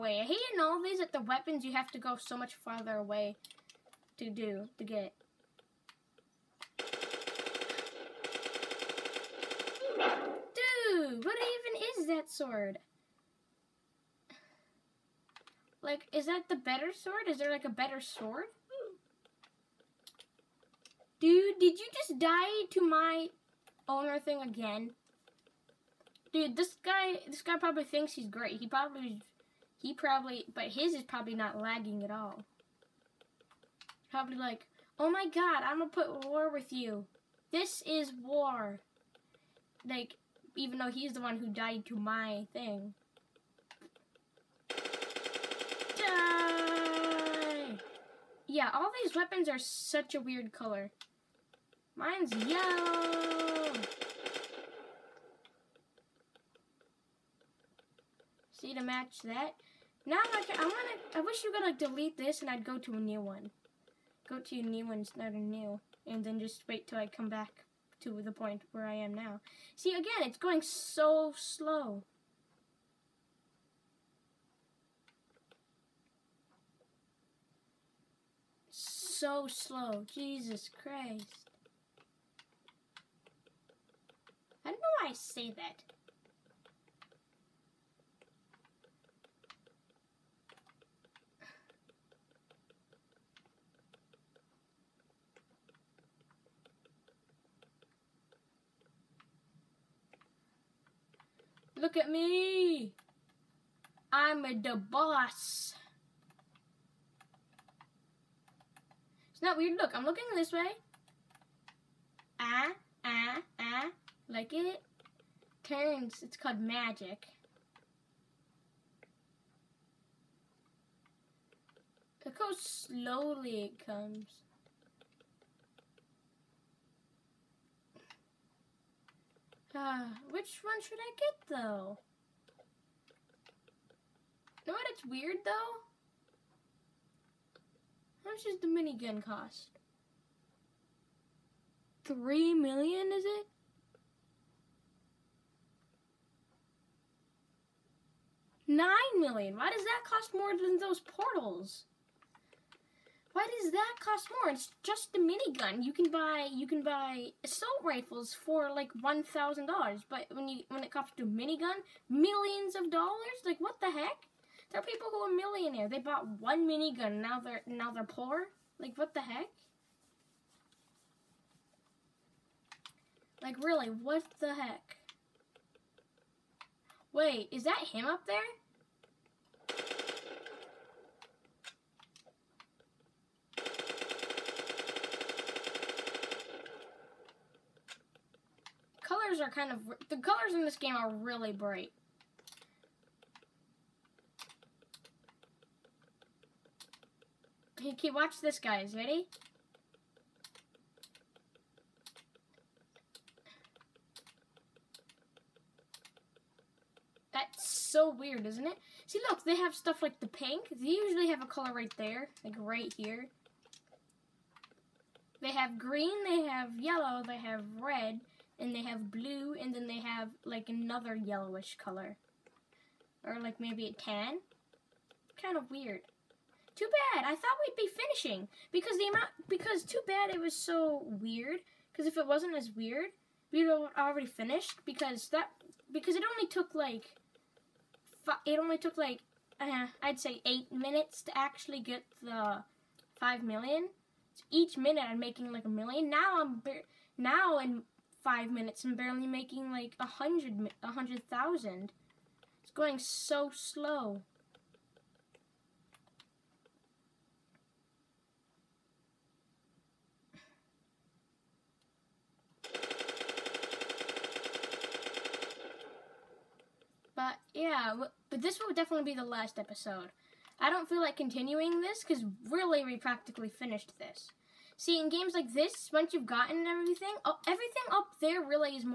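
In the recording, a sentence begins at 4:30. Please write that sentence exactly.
I don't feel like continuing this because really we practically finished this.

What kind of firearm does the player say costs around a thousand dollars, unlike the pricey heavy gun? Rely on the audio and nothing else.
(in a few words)
Assault rifles.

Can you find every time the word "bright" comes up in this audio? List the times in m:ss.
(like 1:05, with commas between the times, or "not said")
3:11.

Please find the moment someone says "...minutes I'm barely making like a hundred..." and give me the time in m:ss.
4:08.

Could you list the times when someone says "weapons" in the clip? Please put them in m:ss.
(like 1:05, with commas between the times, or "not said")
0:01, 0:49.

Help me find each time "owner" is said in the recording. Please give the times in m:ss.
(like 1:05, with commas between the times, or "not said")
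0:23.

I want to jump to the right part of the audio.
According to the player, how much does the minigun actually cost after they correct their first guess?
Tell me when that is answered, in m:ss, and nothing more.
2:28.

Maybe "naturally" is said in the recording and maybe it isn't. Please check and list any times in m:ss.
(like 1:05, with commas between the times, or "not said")
not said.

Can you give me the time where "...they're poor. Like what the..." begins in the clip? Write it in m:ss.
2:47.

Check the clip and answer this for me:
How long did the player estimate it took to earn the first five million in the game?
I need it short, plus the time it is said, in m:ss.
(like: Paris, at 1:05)
8 minutes, at 4:00.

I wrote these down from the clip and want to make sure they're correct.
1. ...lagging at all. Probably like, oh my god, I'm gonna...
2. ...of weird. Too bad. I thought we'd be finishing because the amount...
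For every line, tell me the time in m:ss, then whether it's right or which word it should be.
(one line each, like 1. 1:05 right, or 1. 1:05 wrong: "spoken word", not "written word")
1. 0:31 right
2. 3:45 right.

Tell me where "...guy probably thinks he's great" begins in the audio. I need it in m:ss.
0:27.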